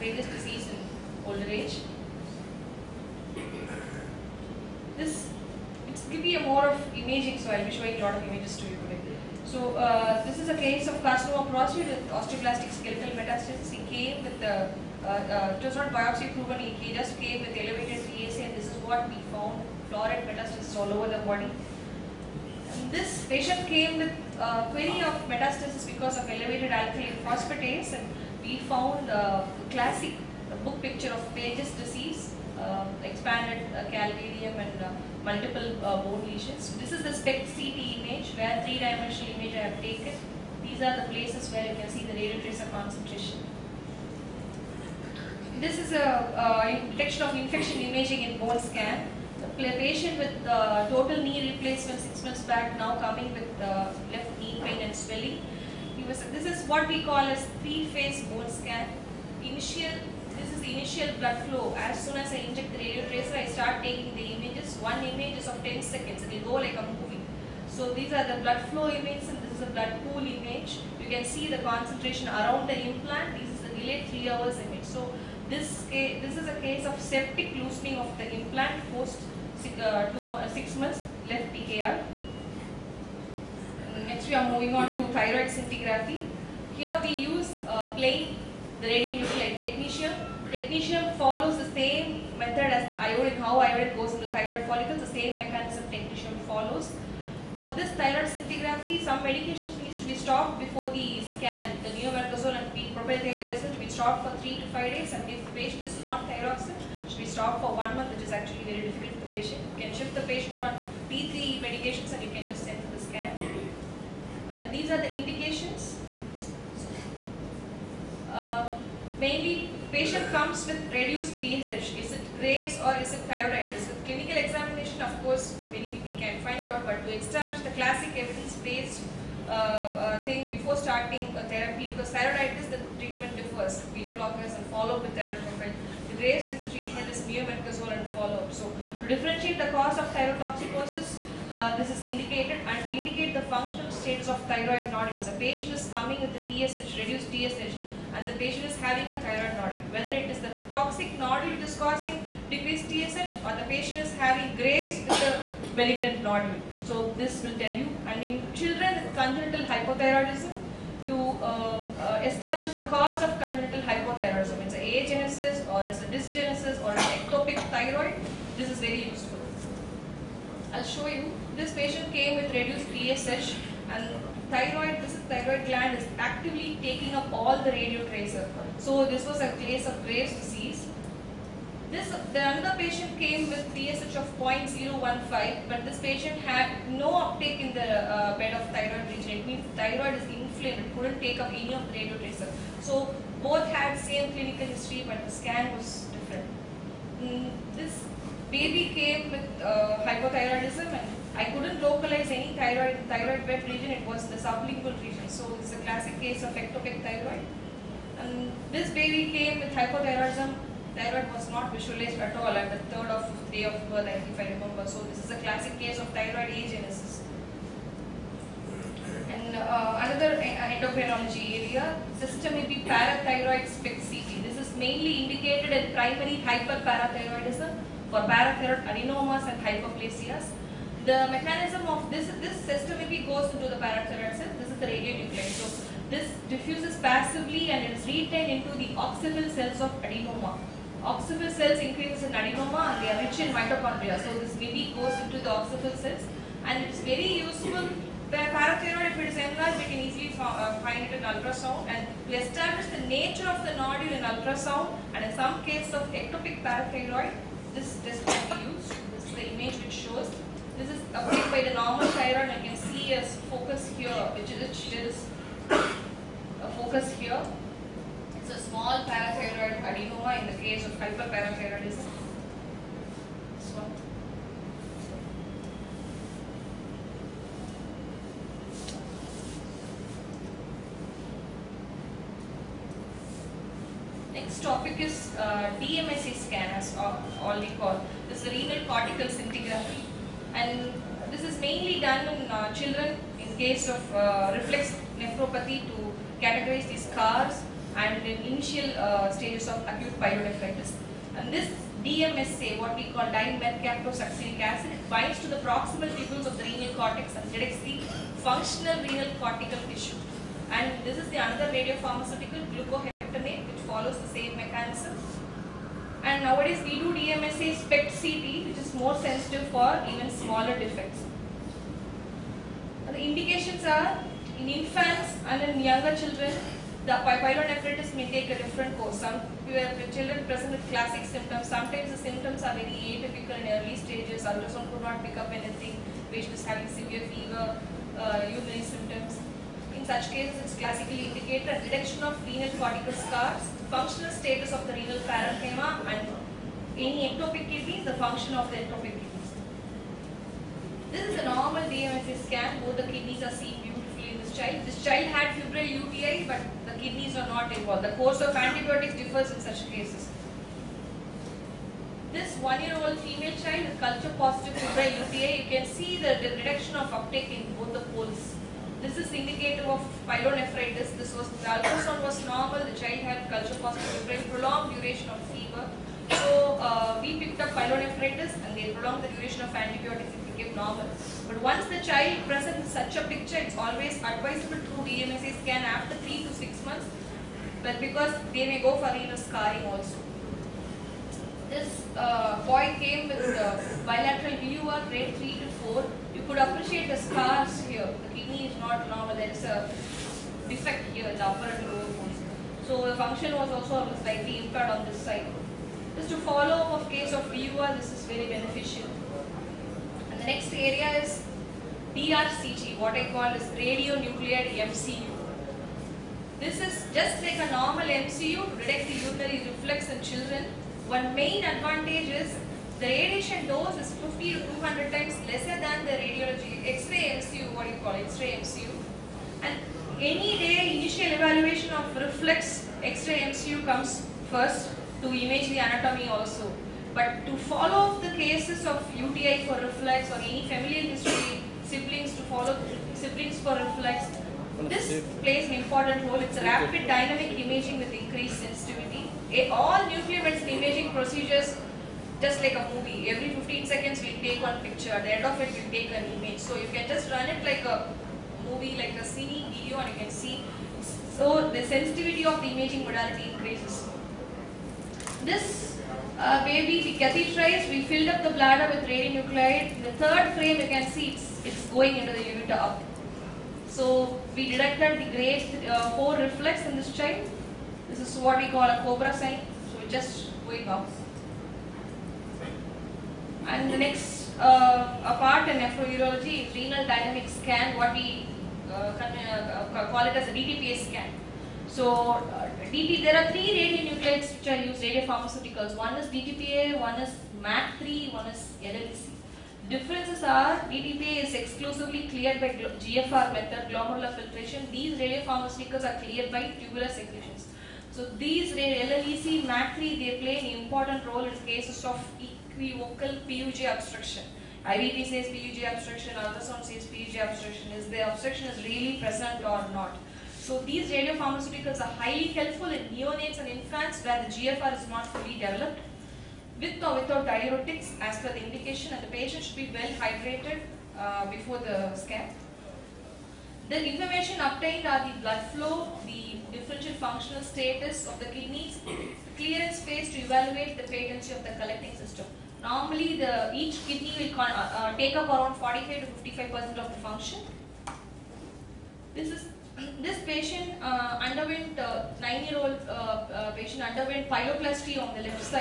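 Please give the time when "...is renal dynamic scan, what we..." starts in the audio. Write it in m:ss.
8:06.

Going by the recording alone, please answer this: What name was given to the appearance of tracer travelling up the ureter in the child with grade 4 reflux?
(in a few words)
cobra sign.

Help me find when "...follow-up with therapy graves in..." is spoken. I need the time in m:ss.
2:14.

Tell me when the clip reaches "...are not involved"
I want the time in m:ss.
5:57.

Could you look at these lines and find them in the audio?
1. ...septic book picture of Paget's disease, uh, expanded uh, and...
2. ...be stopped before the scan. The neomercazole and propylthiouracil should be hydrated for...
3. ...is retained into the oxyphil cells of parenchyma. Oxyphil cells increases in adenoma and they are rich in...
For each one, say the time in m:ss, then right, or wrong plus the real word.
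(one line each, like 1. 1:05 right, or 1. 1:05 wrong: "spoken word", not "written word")
1. 0:29 wrong: "classic", not "septic"
2. 1:40 wrong: "stopped", not "hydrated"
3. 3:57 wrong: "adenoma", not "parenchyma".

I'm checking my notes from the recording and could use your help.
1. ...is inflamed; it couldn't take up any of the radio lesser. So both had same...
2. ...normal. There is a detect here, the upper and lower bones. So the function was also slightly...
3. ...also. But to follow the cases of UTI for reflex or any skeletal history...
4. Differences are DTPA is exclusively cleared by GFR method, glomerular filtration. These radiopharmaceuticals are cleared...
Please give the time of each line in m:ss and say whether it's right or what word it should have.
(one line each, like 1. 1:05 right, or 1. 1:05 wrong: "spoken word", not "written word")
1. 3:10 wrong: "tracer", not "lesser"
2. 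6:39 wrong: "defect", not "detect"
3. 7:16 wrong: "familial", not "skeletal"
4. 8:19 right.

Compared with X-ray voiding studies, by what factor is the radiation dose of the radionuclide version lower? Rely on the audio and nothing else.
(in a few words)
50 to 200 times.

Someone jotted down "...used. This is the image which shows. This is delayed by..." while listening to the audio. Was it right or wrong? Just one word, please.
wrong.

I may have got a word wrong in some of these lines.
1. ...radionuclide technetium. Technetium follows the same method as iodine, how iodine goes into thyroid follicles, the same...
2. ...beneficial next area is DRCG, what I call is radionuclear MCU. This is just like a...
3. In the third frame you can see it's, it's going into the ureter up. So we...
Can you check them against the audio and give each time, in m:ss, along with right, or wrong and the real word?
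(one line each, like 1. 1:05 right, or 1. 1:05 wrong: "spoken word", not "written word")
1. 1:28 right
2. 6:48 right
3. 7:49 right.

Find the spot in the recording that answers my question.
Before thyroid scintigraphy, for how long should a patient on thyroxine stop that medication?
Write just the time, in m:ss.
1:47.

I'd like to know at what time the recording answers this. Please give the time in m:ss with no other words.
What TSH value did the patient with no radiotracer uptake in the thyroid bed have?
3:04.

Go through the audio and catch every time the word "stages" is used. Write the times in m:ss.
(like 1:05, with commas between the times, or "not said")
4:59, 5:33.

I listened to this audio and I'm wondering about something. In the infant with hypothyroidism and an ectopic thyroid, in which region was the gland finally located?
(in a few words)
sublingual region.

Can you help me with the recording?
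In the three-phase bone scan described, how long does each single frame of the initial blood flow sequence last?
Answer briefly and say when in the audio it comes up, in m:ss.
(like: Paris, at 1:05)
10 seconds, at 1:05.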